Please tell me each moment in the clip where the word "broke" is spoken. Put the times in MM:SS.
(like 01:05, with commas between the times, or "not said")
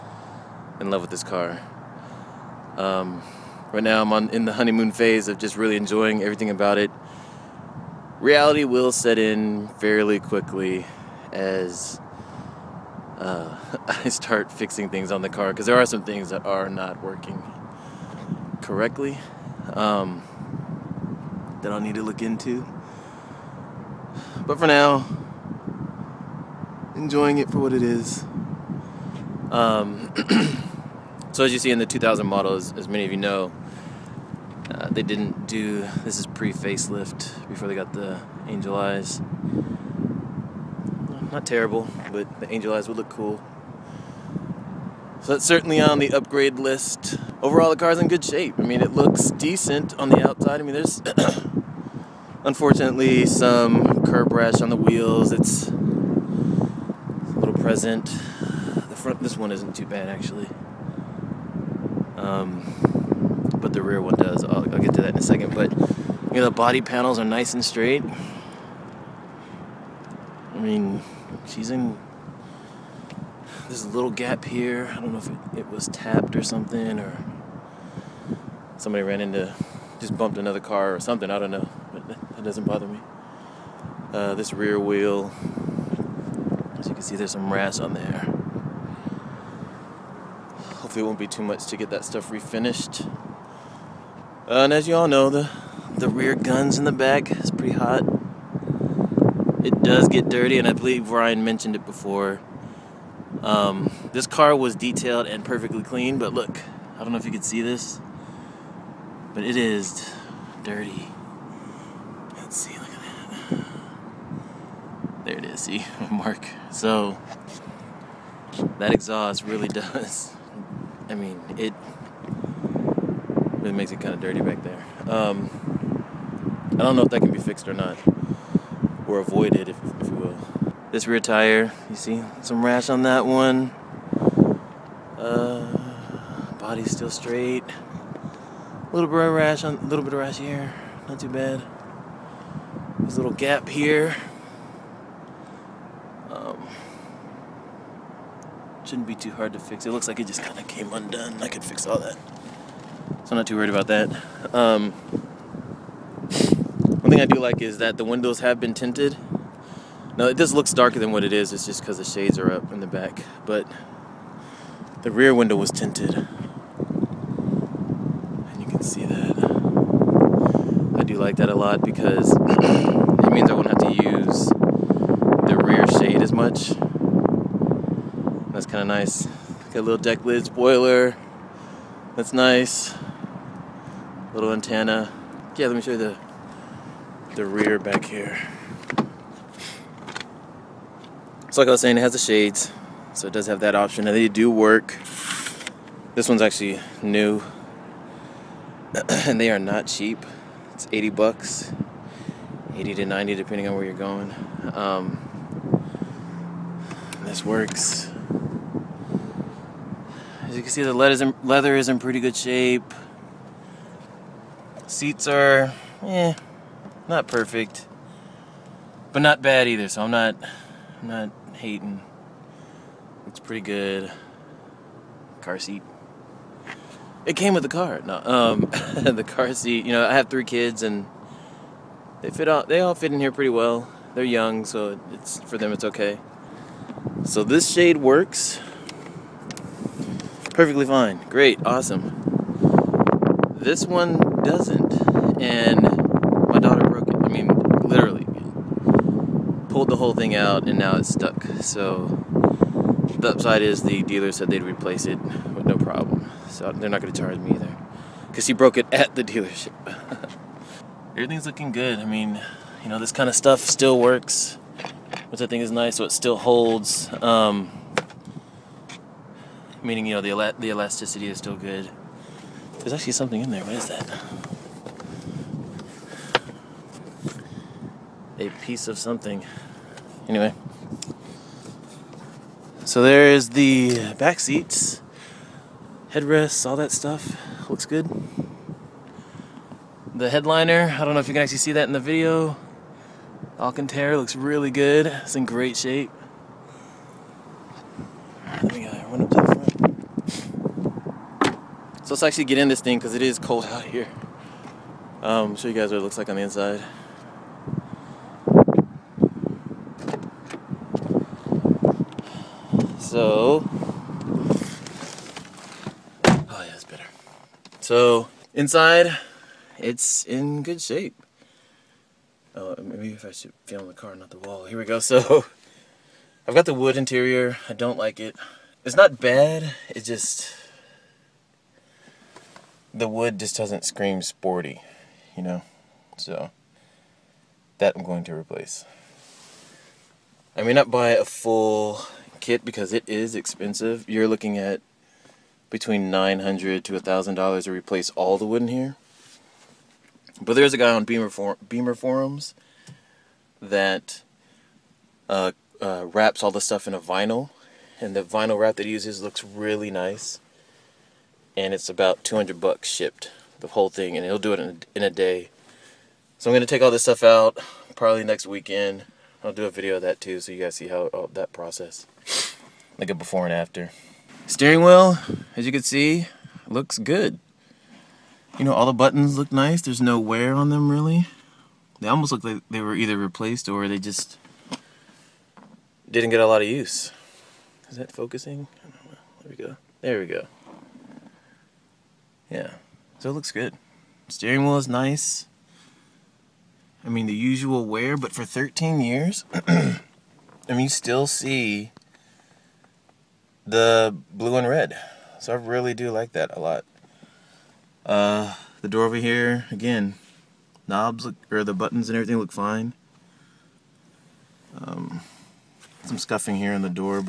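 04:06, 04:18.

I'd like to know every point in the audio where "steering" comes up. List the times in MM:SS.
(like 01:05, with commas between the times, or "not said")
06:14, 06:34.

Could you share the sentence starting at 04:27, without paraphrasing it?
Um, meaning you know the el- the elasticity is still good.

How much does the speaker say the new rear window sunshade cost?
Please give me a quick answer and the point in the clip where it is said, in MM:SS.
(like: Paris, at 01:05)
80 bucks, at 03:20.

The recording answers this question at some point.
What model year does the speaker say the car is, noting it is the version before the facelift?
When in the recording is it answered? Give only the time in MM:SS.
00:31.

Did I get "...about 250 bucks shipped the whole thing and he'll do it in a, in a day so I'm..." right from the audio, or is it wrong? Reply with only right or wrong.
wrong.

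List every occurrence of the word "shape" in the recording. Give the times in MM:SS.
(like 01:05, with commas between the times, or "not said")
00:48, 03:32, 04:55, 05:20.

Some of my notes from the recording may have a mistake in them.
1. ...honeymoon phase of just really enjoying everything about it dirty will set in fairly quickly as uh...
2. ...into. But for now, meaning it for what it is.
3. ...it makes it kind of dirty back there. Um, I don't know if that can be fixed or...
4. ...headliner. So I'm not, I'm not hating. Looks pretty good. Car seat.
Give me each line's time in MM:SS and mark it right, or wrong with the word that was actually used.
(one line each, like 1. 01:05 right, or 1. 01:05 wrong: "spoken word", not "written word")
1. 00:04 wrong: "reality", not "dirty"
2. 00:22 wrong: "enjoying", not "meaning"
3. 02:03 right
4. 03:39 wrong: "either", not "headliner".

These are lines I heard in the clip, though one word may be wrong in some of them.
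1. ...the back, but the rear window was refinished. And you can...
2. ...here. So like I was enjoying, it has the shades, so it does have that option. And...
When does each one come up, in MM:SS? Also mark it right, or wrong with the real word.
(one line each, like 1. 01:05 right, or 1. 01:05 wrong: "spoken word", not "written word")
1. 02:42 wrong: "tinted", not "refinished"
2. 03:08 wrong: "saying", not "enjoying".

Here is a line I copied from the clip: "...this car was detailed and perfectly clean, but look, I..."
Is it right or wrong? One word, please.
right.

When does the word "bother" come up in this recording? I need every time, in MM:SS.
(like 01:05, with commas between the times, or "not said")
01:22.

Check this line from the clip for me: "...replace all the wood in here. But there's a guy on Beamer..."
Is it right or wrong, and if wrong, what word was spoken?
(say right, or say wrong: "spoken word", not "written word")
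right.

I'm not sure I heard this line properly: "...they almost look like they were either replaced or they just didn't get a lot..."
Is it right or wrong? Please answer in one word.
right.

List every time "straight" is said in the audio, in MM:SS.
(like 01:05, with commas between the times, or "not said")
01:07, 02:17.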